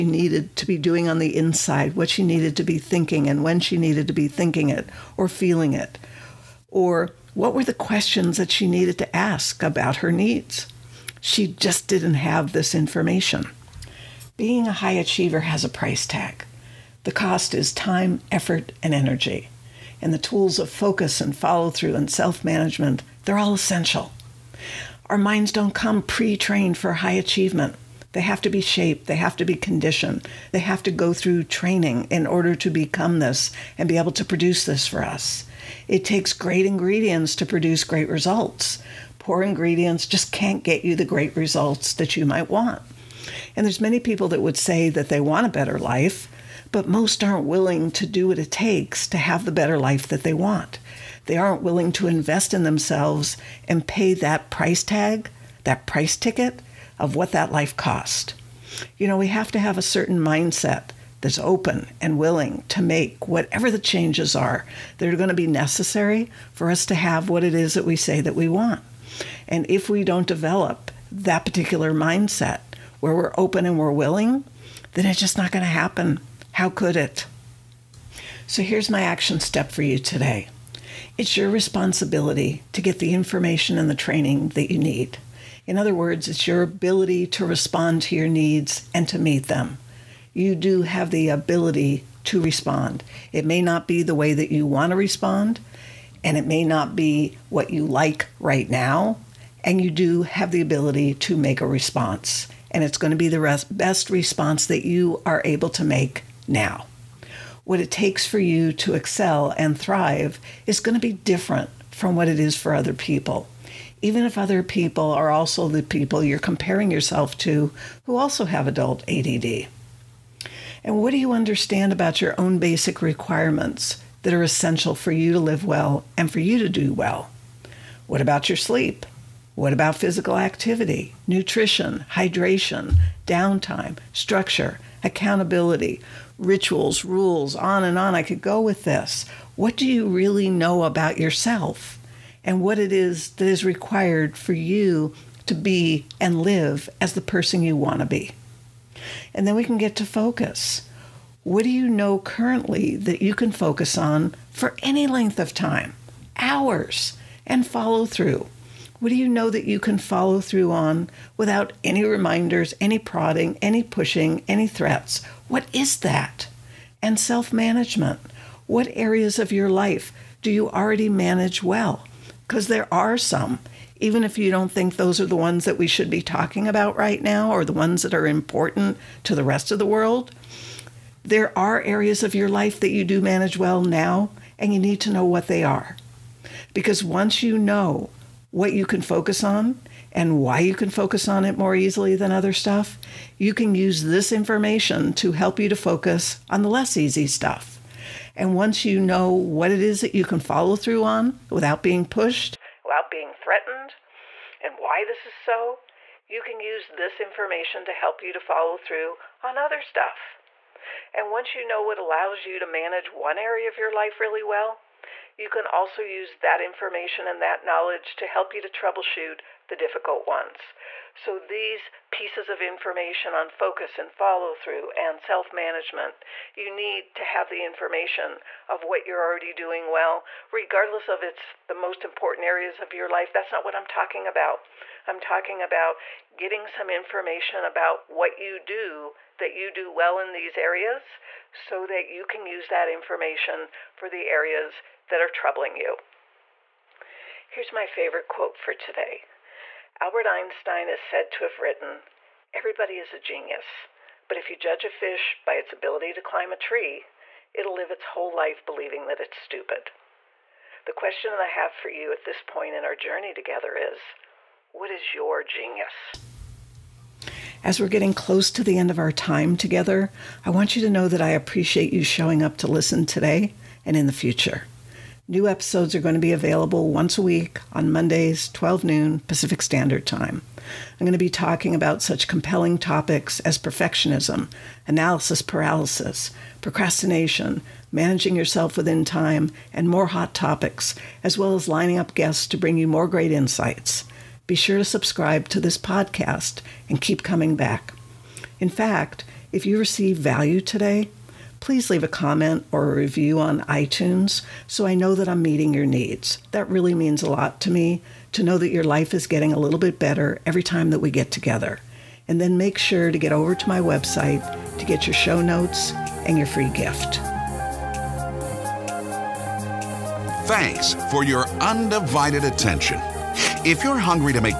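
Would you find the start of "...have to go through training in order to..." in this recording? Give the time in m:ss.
0:30.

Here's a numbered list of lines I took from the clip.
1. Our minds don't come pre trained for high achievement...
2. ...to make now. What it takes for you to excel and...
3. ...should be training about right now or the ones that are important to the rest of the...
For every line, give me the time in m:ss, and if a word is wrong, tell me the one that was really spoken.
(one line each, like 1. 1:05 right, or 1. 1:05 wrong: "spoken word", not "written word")
1. 0:25 right
2. 1:45 right
3. 2:55 wrong: "talking", not "training".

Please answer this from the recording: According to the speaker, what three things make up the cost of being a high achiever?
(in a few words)
time, effort, and energy.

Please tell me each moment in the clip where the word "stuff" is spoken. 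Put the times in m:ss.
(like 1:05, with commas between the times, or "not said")
3:12, 3:17, 3:29.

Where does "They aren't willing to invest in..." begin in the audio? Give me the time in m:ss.
0:51.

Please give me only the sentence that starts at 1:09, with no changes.
And if we don't develop that particular mindset where we're open and we're willing, then it's just not going to happen.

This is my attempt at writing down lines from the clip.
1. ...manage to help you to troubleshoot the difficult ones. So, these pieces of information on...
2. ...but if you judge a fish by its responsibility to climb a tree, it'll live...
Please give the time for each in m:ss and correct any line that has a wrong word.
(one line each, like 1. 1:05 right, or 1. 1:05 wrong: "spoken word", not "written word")
1. 3:37 wrong: "knowledge", not "manage"
2. 4:14 wrong: "ability", not "responsibility".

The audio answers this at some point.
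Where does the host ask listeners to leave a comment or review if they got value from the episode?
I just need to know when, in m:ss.
5:03.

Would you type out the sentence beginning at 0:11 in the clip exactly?
She just didn't have this information.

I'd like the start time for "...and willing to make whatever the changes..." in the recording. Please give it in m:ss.
1:02.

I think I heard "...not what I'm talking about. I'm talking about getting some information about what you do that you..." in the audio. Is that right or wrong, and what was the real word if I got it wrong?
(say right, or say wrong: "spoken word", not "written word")
right.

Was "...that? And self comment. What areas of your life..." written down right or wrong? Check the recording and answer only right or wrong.
wrong.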